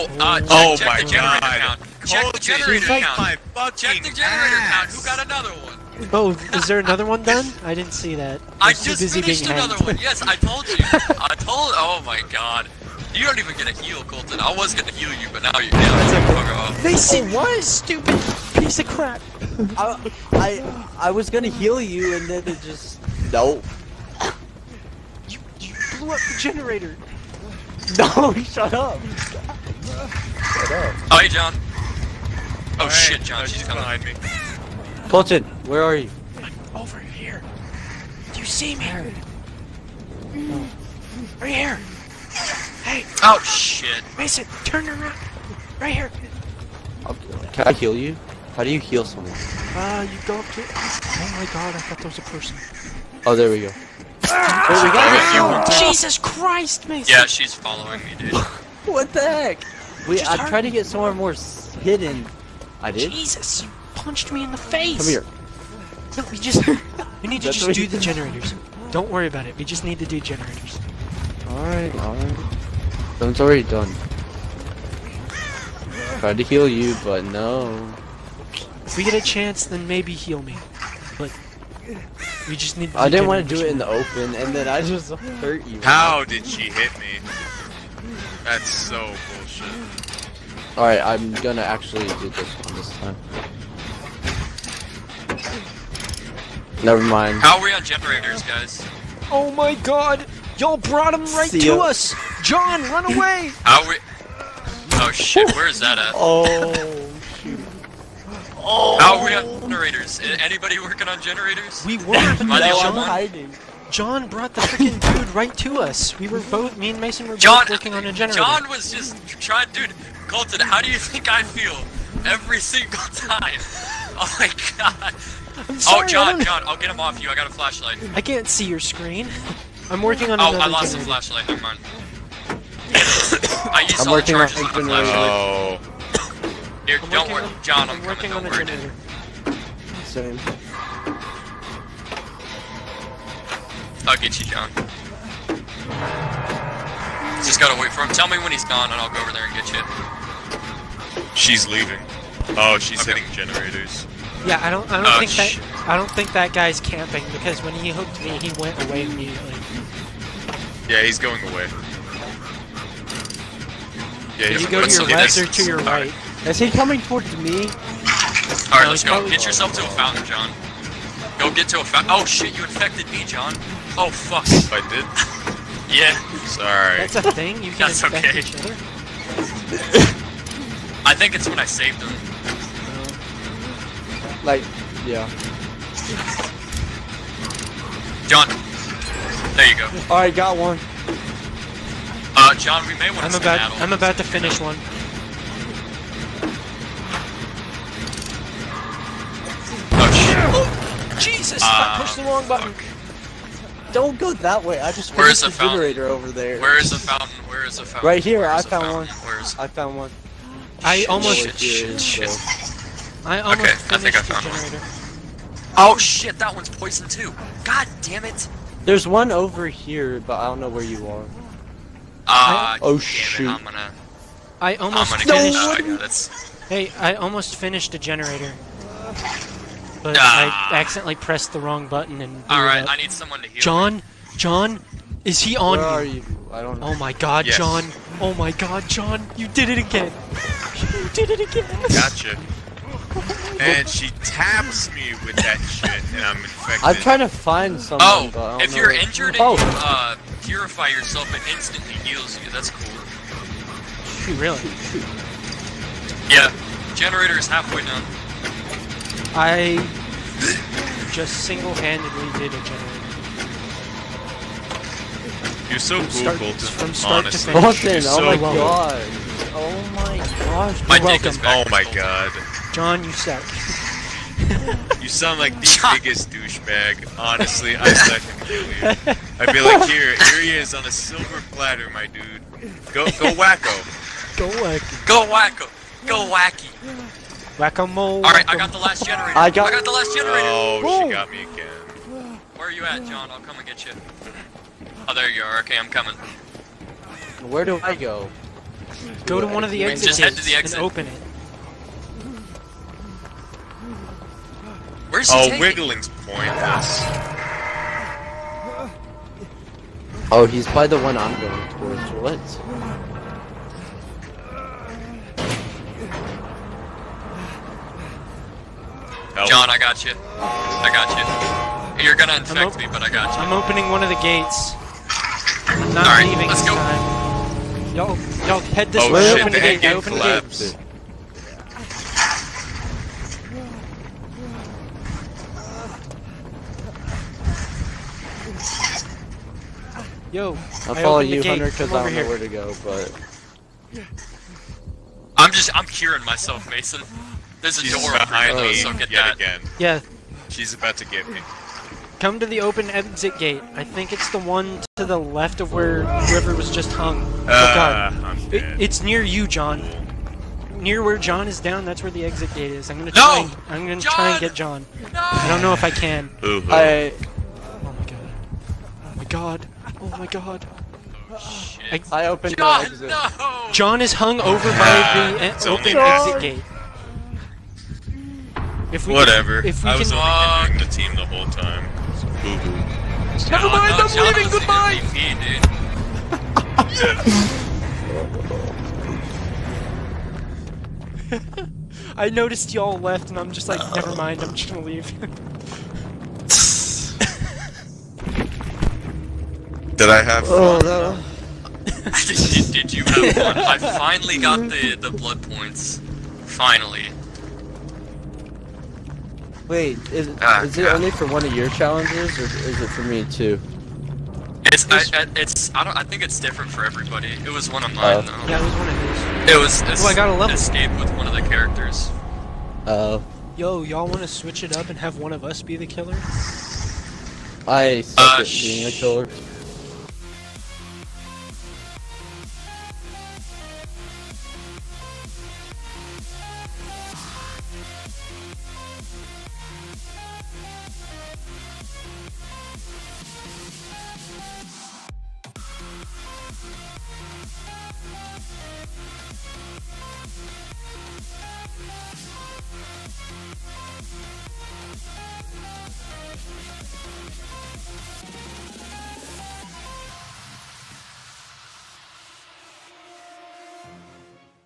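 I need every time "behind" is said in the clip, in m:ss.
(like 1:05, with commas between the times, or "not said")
0:33, 5:48.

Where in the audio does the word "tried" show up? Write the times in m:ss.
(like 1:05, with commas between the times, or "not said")
1:00, 1:16.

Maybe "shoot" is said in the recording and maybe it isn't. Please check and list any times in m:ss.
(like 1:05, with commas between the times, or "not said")
1:47, 3:42, 4:14.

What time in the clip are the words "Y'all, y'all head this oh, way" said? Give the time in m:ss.
5:27.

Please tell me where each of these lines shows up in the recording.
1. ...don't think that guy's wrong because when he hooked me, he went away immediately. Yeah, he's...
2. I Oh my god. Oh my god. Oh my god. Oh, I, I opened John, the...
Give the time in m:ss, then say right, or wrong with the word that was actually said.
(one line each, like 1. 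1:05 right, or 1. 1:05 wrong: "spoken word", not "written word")
1. 2:35 wrong: "camping", not "wrong"
2. 6:06 right.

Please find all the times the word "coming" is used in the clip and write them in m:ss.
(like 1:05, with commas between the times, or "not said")
0:33, 2:18, 2:46, 4:55.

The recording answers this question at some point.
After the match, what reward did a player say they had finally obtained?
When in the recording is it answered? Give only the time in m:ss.
6:44.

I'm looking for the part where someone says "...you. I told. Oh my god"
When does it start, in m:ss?
0:10.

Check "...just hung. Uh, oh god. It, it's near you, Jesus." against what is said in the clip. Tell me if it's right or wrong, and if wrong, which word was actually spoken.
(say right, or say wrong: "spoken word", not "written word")
wrong: "John", not "Jesus".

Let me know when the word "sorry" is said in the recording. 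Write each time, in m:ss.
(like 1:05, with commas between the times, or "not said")
2:05, 2:56.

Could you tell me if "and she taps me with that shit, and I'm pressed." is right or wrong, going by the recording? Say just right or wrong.
wrong.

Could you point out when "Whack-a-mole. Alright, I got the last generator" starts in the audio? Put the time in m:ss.
4:47.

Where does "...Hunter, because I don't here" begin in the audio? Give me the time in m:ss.
5:41.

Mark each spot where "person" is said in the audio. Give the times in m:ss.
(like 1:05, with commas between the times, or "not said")
0:52.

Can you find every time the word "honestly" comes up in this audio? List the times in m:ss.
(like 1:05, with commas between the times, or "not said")
4:27, 4:37.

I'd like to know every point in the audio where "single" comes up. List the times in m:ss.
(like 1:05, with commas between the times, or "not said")
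2:02, 4:21.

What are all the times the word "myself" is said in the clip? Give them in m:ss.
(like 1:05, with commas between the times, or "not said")
5:46.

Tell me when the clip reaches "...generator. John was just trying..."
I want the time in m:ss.
1:58.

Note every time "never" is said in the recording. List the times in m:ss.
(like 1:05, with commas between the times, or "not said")
1:36, 2:11, 6:23, 6:33.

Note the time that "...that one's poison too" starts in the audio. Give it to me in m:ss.
3:36.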